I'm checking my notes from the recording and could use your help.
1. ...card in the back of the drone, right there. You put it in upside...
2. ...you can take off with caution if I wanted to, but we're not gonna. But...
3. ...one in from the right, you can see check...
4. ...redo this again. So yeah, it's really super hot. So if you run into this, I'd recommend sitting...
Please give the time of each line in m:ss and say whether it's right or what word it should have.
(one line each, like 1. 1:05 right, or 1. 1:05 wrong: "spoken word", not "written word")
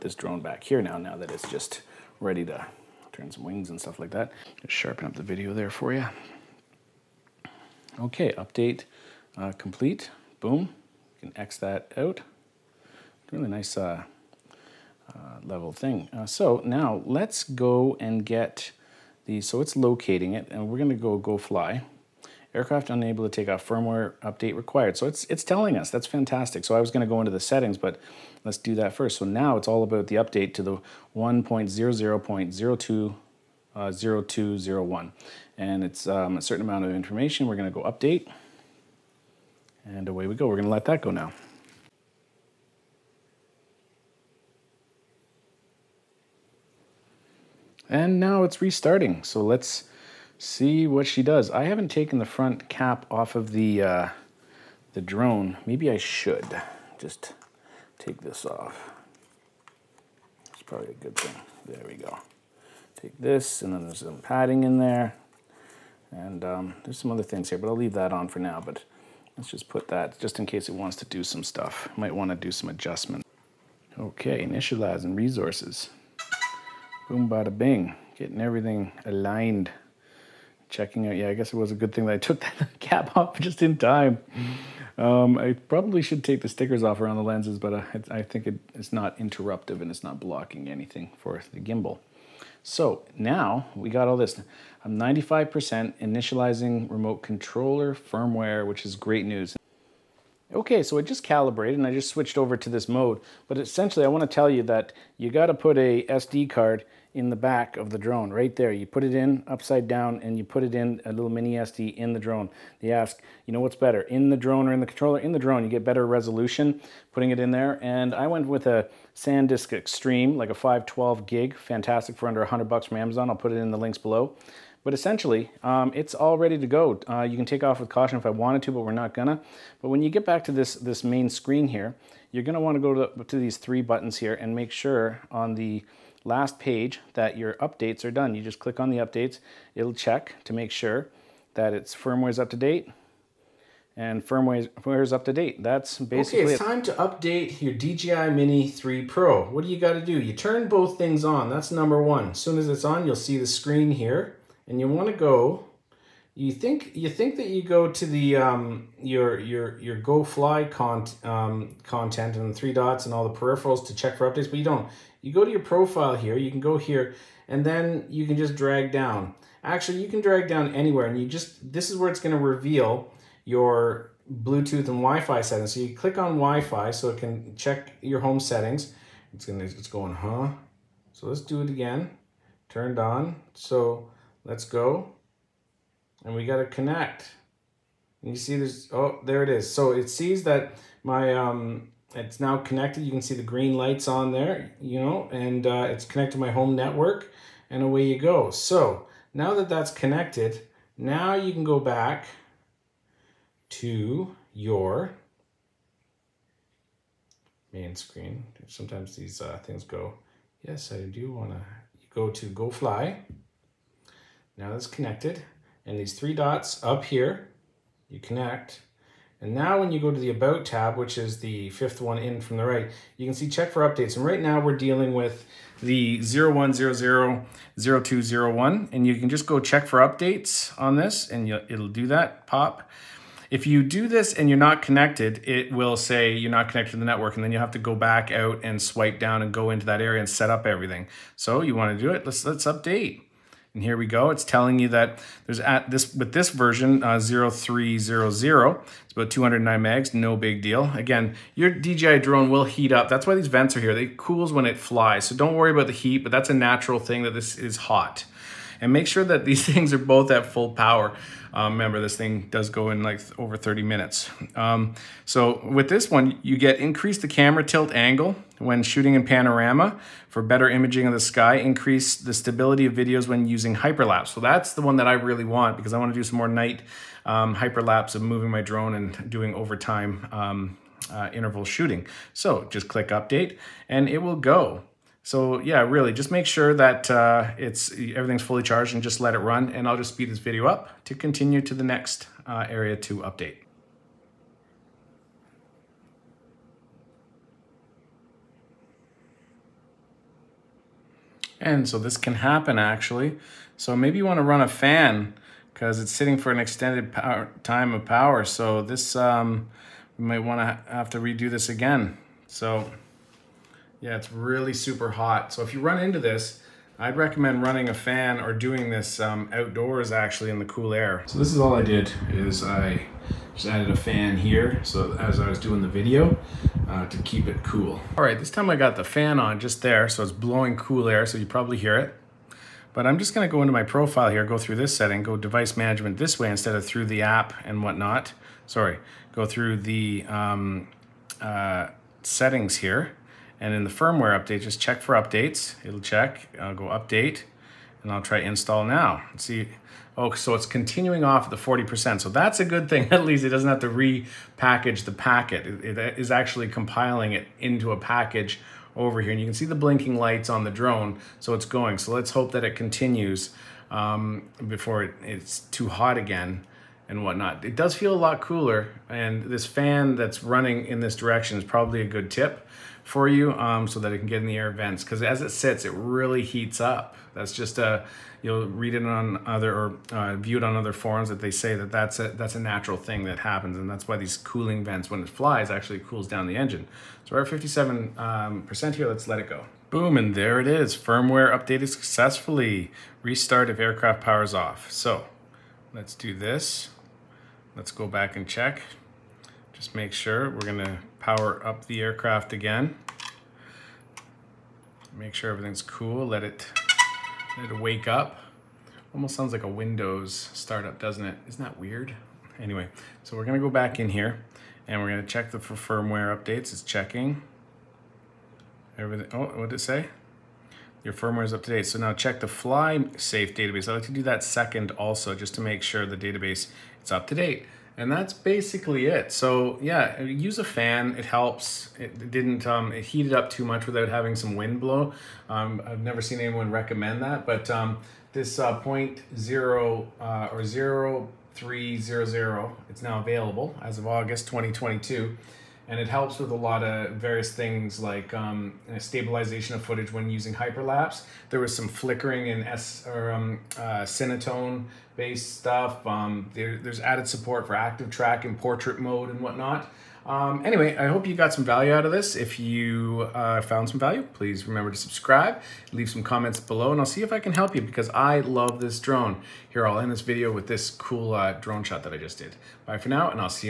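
1. 1:46 right
2. 2:07 right
3. 3:42 right
4. 5:11 wrong: "running", not "sitting".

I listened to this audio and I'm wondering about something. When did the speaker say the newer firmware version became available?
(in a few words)
August 2022.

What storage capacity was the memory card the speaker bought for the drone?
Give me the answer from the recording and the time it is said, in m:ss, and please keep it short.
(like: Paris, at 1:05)
512 gig, at 2:00.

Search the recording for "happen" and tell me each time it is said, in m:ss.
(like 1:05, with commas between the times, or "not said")
5:02, 6:23.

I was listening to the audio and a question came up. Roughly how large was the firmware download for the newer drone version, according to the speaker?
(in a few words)
209 megs.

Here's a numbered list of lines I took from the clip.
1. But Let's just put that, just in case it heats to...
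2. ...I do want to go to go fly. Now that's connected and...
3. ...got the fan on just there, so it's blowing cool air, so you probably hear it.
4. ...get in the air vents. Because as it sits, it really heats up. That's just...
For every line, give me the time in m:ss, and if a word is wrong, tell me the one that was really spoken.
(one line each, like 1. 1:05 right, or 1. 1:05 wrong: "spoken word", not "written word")
1. 1:08 wrong: "wants", not "heats"
2. 3:30 right
3. 5:28 right
4. 6:14 right.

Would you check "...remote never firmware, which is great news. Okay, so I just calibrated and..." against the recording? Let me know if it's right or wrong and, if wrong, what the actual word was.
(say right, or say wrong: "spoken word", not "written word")
wrong: "controller", not "never".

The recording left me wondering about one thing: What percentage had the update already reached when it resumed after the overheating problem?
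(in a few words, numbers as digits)
40%.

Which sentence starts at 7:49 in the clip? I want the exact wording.
Here, I'll end this video with this cool uh, drone shot that I just did.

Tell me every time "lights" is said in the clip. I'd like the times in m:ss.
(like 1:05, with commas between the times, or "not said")
3:13, 6:00.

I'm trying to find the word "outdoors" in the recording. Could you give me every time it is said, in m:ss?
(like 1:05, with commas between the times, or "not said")
5:19.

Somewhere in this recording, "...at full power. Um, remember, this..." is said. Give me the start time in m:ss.
4:20.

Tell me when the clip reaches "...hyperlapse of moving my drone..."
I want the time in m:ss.
4:37.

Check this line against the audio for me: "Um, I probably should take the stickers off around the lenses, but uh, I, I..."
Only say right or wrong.
right.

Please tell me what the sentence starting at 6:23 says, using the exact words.
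And that's why these cooling vents, when it flies, actually cools down the engine.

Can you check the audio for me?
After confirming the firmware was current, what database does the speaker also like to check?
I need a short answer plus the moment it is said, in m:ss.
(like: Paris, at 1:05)
fly safe database, at 7:02.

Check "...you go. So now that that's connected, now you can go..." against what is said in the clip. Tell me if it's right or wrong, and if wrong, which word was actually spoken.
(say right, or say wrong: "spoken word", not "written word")
right.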